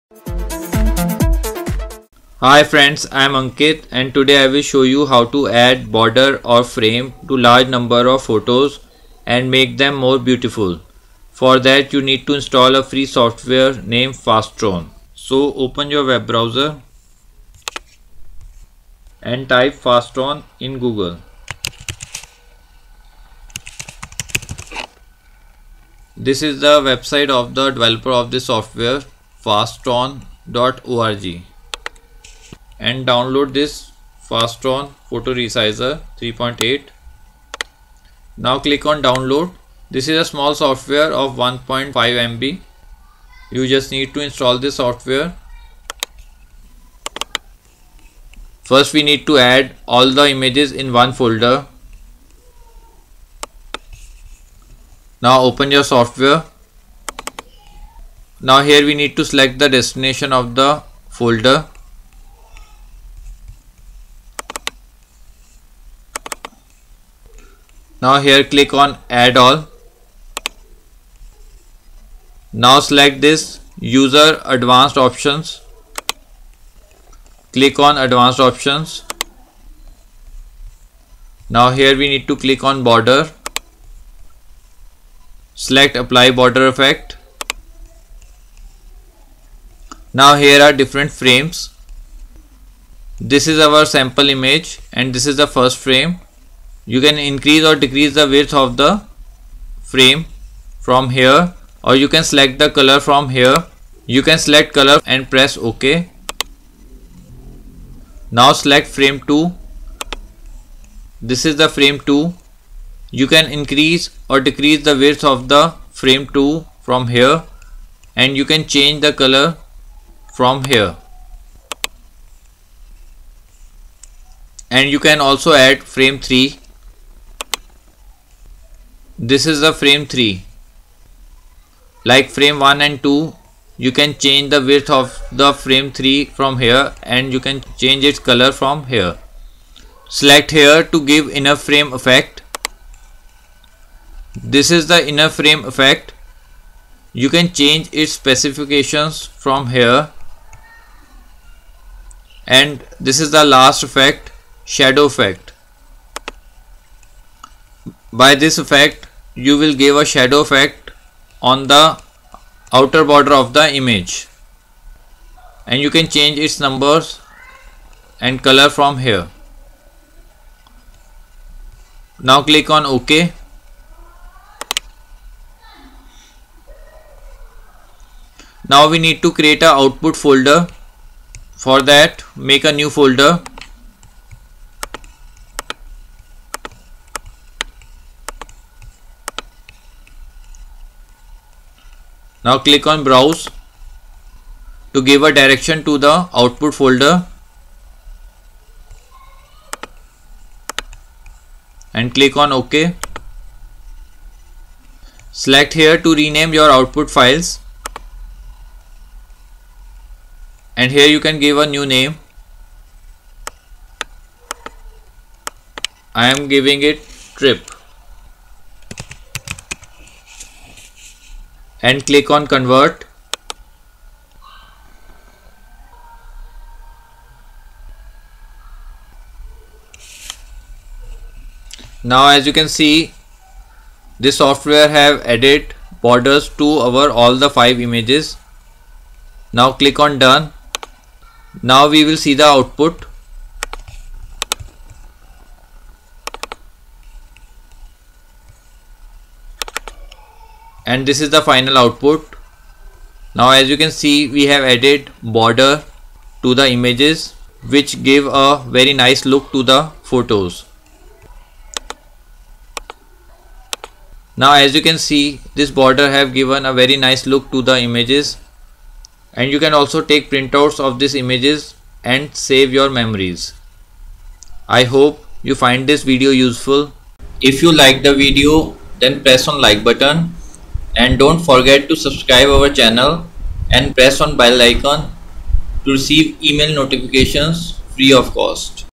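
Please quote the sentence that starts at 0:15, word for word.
So open your web browser and type FastStone in Google.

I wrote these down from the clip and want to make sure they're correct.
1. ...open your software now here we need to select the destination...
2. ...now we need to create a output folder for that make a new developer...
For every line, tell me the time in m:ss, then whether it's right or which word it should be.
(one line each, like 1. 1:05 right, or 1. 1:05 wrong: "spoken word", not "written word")
1. 0:55 right
2. 2:58 wrong: "folder", not "developer".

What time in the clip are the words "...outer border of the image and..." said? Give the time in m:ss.
2:42.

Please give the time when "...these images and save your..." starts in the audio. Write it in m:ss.
4:30.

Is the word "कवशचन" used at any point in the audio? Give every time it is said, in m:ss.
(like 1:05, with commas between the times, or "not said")
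not said.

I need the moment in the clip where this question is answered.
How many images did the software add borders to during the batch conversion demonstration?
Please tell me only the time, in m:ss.
3:57.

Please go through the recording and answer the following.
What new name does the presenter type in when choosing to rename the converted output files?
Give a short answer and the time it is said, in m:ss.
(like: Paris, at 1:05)
trip, at 3:37.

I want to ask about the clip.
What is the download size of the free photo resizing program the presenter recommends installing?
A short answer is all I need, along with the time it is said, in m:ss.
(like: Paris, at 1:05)
1.5 MB, at 0:41.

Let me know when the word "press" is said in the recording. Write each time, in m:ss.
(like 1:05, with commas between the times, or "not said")
1:45, 4:39, 4:43.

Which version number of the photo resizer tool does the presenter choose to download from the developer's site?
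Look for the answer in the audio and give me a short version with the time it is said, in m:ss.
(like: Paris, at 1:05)
3.8, at 0:36.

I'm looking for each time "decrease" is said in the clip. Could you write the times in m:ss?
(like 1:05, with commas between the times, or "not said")
1:37, 1:54.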